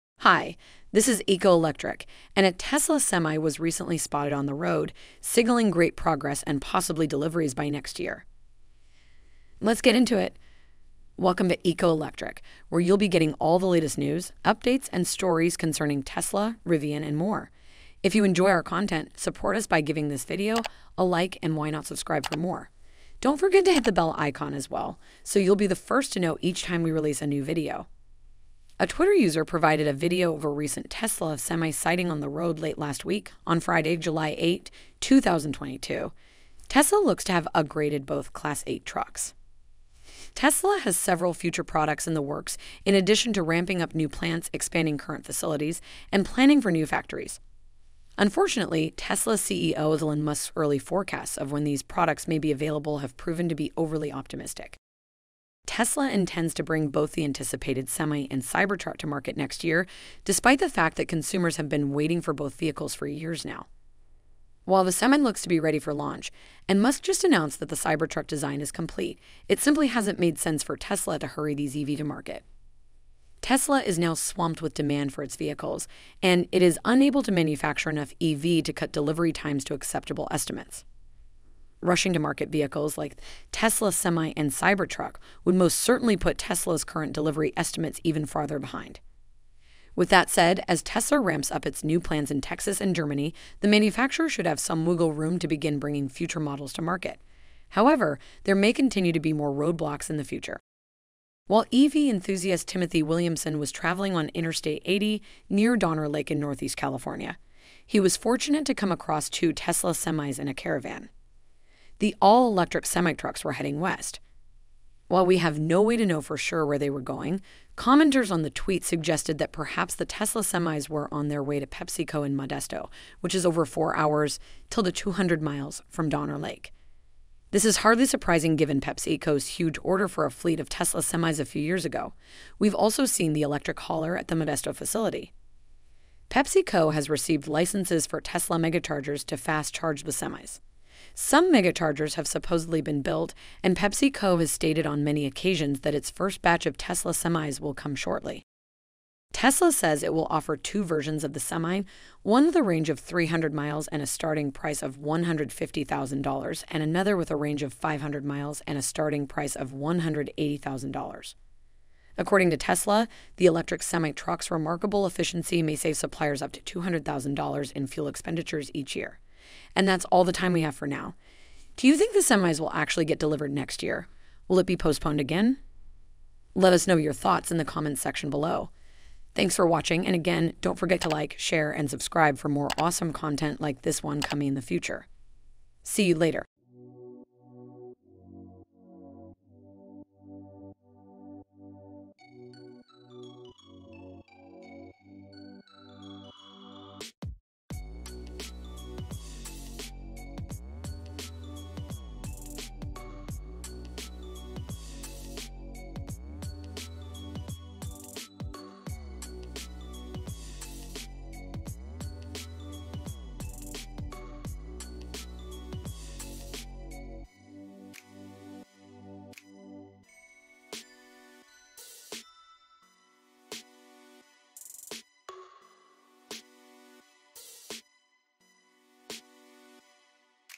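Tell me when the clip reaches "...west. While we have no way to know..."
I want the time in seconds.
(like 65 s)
113 s.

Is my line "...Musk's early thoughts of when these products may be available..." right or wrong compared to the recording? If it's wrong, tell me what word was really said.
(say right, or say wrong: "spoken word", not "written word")
wrong: "forecasts", not "thoughts".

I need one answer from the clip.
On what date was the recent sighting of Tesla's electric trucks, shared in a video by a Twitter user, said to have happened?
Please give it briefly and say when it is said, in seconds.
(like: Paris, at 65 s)
July 8, 2022, at 33 s.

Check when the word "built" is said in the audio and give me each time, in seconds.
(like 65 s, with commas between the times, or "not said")
143 s.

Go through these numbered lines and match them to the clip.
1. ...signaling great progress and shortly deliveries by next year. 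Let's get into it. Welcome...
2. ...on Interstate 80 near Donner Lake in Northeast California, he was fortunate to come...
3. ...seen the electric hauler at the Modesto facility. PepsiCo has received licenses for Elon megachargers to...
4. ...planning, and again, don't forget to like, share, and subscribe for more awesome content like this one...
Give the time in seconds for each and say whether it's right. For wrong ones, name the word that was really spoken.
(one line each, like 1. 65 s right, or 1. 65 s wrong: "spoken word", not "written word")
1. 5 s wrong: "possibly", not "shortly"
2. 104 s right
3. 133 s wrong: "Tesla", not "Elon"
4. 179 s wrong: "watching", not "planning".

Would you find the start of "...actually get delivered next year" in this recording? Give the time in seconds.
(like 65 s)
172 s.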